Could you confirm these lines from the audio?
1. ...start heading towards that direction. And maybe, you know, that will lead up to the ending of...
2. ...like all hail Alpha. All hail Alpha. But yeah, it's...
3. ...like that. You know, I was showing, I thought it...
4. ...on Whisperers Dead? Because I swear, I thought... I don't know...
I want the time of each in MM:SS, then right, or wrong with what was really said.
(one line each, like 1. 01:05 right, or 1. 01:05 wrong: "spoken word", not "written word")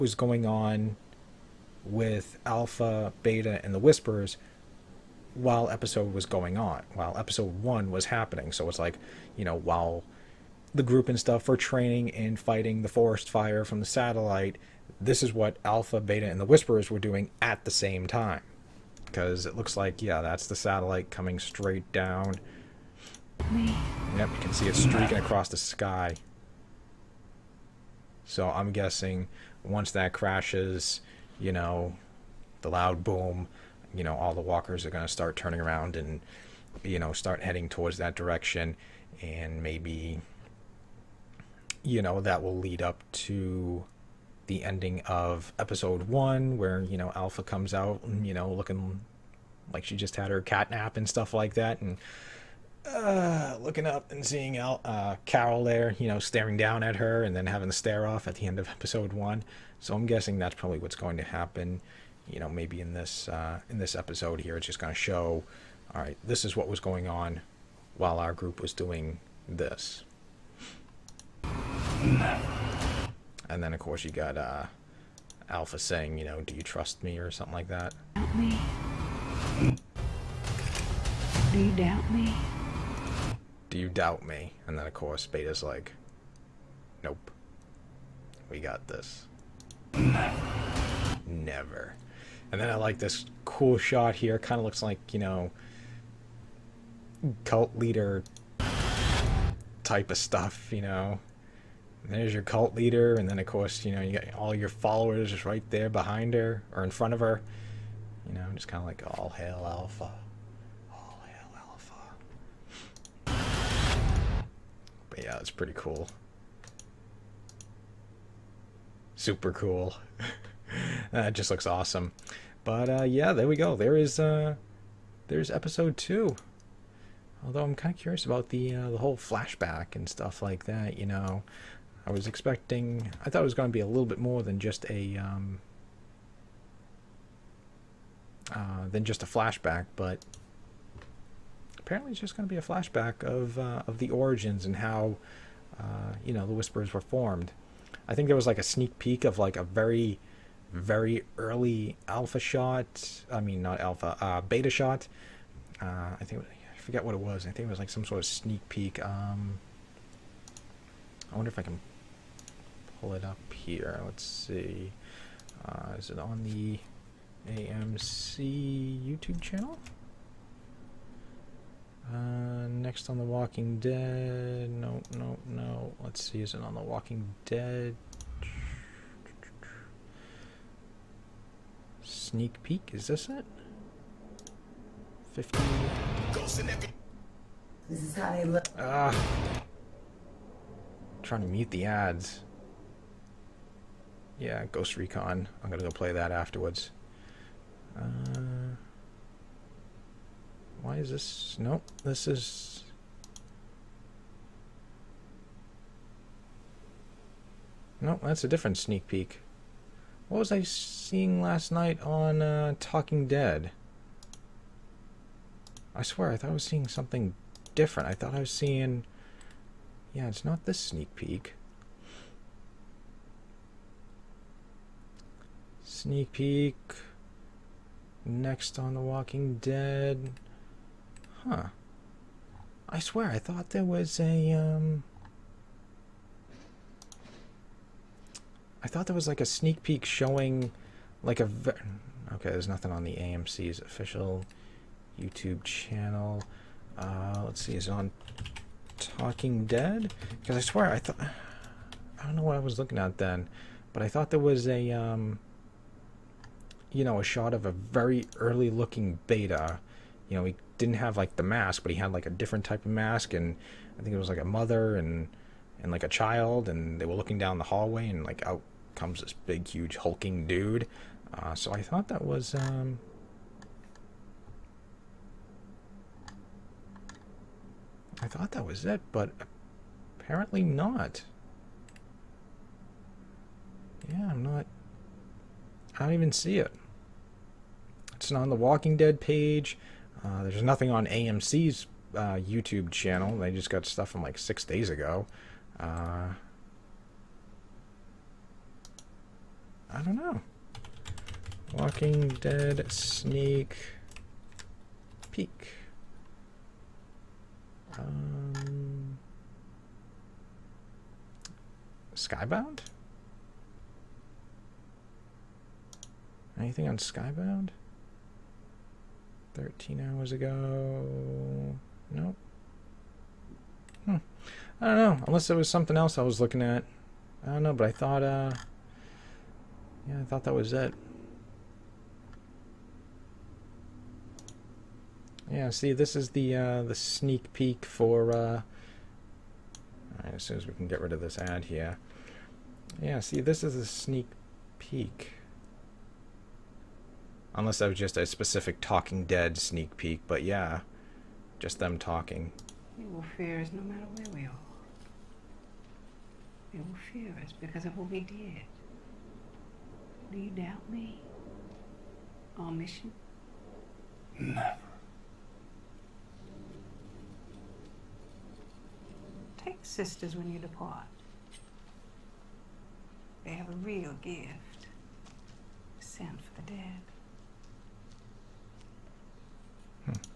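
1. 00:37 right
2. 01:48 right
3. 02:10 wrong: "expecting", not "showing"
4. 04:07 wrong: "Talking", not "Whisperers".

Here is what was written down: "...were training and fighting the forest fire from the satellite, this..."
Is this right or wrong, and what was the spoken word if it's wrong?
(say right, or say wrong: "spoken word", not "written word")
right.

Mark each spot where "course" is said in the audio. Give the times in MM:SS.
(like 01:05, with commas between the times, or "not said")
01:13, 01:24, 01:43.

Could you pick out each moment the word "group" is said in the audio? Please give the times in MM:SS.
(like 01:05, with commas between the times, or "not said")
00:10, 01:08.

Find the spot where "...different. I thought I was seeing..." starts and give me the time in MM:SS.
03:37.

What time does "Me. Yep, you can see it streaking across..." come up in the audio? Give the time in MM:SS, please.
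00:23.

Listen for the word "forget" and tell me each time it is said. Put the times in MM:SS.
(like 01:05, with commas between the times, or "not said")
02:36.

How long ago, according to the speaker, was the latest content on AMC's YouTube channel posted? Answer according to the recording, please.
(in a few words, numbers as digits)
6 days ago.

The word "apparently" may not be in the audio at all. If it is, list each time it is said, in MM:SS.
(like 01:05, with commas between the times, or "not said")
02:21, 04:40.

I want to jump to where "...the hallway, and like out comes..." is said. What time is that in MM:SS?
04:27.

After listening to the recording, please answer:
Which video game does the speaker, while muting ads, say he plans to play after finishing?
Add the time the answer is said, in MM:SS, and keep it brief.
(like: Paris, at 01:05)
Ghost Recon, at 03:14.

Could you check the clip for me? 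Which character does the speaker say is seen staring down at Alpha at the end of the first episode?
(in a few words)
Carol.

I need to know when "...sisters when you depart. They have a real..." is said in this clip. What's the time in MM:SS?
06:09.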